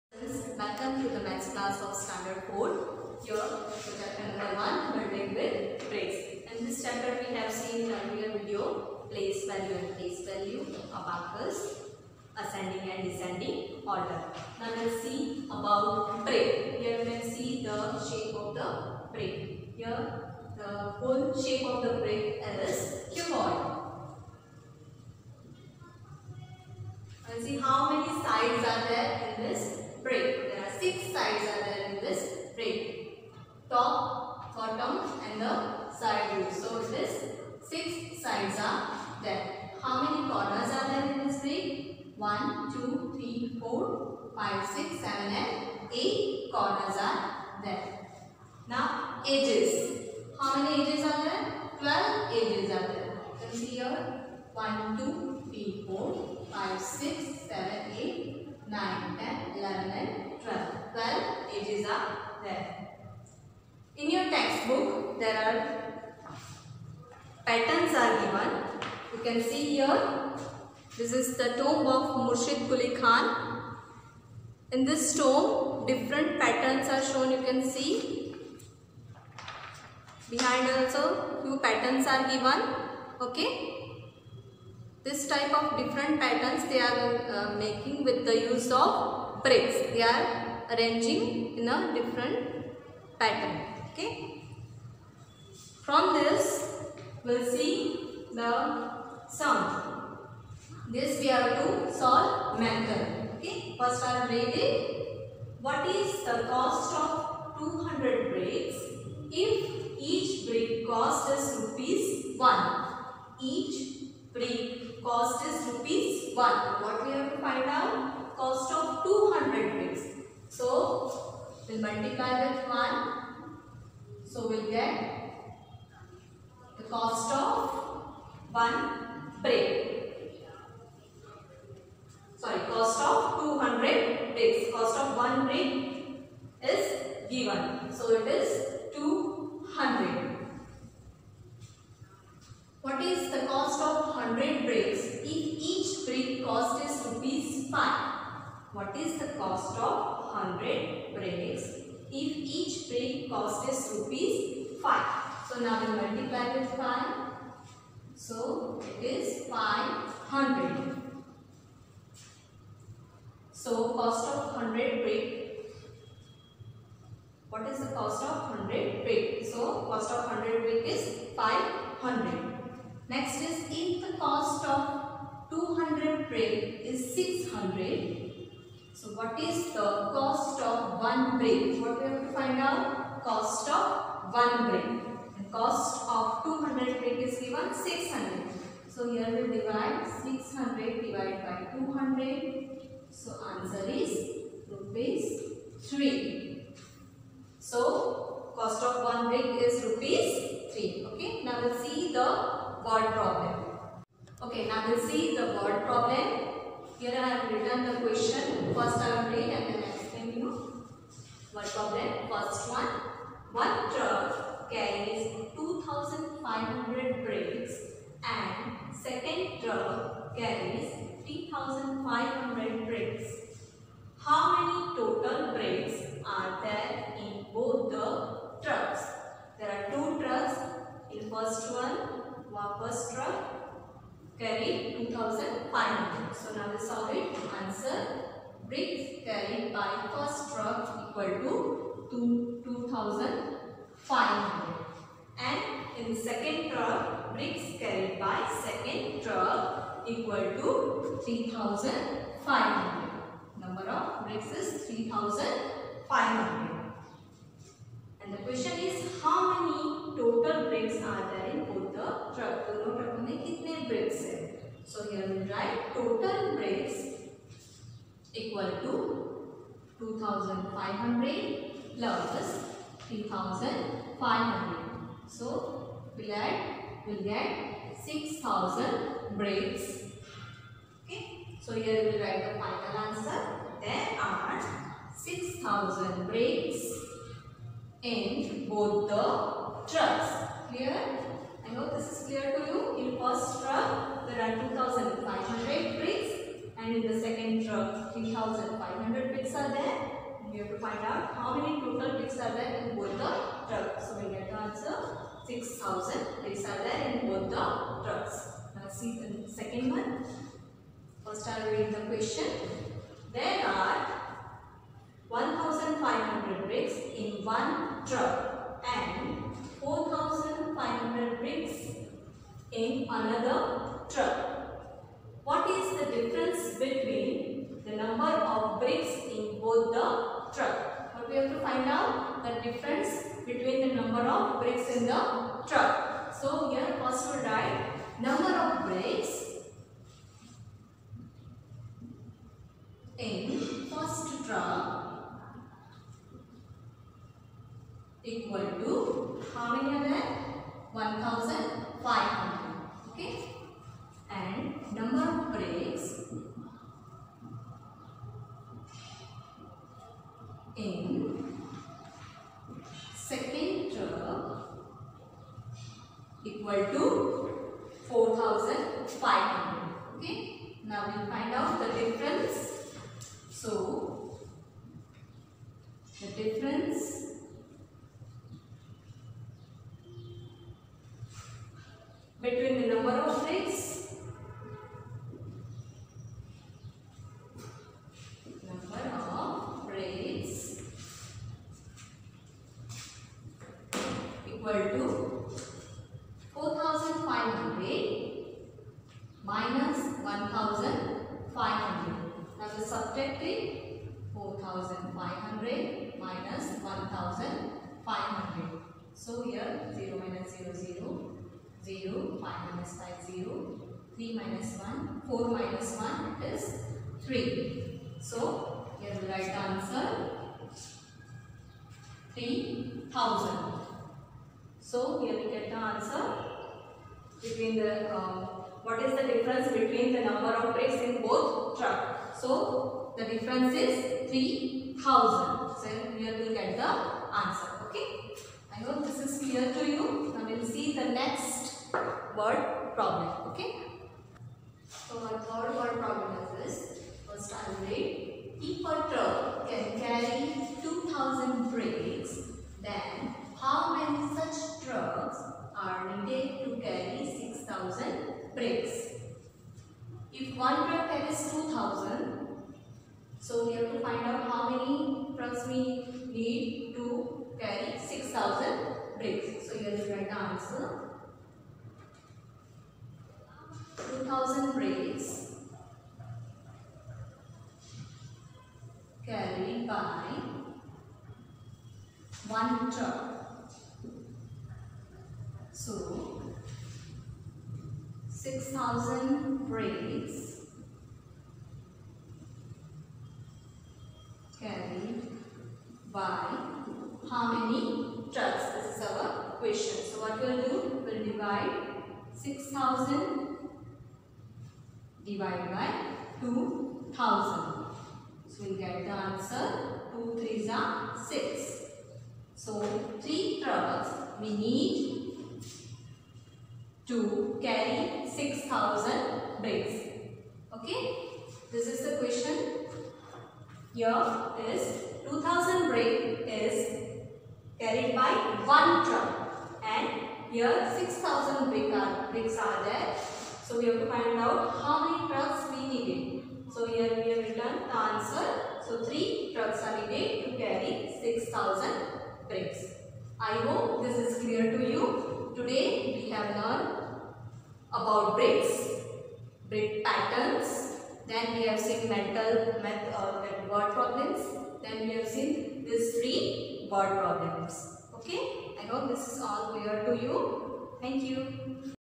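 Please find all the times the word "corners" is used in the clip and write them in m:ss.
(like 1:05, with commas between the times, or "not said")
0:40, 0:46.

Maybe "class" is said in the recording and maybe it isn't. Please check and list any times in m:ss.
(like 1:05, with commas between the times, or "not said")
0:01.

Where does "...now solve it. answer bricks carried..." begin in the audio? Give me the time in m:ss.
3:56.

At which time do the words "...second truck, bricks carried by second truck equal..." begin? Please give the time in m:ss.
4:06.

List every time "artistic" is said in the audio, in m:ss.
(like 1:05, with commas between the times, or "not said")
not said.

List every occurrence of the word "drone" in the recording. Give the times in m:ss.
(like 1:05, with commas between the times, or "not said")
not said.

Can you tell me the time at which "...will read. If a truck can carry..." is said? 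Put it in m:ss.
7:27.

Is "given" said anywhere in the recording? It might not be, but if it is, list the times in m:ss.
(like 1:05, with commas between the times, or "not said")
1:08, 1:22, 2:17, 3:07.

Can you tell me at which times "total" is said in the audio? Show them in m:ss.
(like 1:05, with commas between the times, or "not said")
3:44, 4:20, 4:25, 5:01.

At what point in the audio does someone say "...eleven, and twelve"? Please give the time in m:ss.
0:59.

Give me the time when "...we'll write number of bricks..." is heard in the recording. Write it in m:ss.
5:37.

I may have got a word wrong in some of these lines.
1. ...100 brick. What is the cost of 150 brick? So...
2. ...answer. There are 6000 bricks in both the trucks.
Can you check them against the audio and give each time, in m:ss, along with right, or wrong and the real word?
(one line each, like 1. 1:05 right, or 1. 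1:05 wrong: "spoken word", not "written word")
1. 2:44 wrong: "100", not "150"
2. 4:43 right.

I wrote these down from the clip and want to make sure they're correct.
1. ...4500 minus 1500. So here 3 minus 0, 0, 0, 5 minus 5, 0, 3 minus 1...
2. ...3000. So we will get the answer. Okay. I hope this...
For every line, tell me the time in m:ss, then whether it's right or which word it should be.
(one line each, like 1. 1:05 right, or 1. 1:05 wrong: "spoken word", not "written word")
1. 6:44 wrong: "0", not "3"
2. 7:14 right.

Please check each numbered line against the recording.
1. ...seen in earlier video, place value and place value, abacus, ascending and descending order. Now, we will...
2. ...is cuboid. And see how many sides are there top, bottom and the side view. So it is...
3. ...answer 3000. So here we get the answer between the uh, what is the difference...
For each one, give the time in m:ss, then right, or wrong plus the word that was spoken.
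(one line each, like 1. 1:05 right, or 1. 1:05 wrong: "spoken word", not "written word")
1. 0:07 right
2. 0:22 right
3. 6:59 right.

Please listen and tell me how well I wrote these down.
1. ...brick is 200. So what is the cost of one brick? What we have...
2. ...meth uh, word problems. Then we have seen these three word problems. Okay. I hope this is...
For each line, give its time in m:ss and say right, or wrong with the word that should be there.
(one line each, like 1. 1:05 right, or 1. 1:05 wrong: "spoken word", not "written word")
1. 2:56 wrong: "600", not "200"
2. 9:12 right.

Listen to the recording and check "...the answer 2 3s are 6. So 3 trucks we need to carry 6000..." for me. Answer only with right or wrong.
right.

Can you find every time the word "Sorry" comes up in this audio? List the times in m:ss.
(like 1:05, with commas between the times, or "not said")
2:12.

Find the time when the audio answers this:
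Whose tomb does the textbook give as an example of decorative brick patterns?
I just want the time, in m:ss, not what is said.
1:12.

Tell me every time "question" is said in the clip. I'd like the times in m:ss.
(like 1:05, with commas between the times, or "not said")
3:28, 4:18, 5:12, 8:19, 8:42.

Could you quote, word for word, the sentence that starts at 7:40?
If one truck carries 2000, so we have to find out how many trucks we need to carry 6000 bricks.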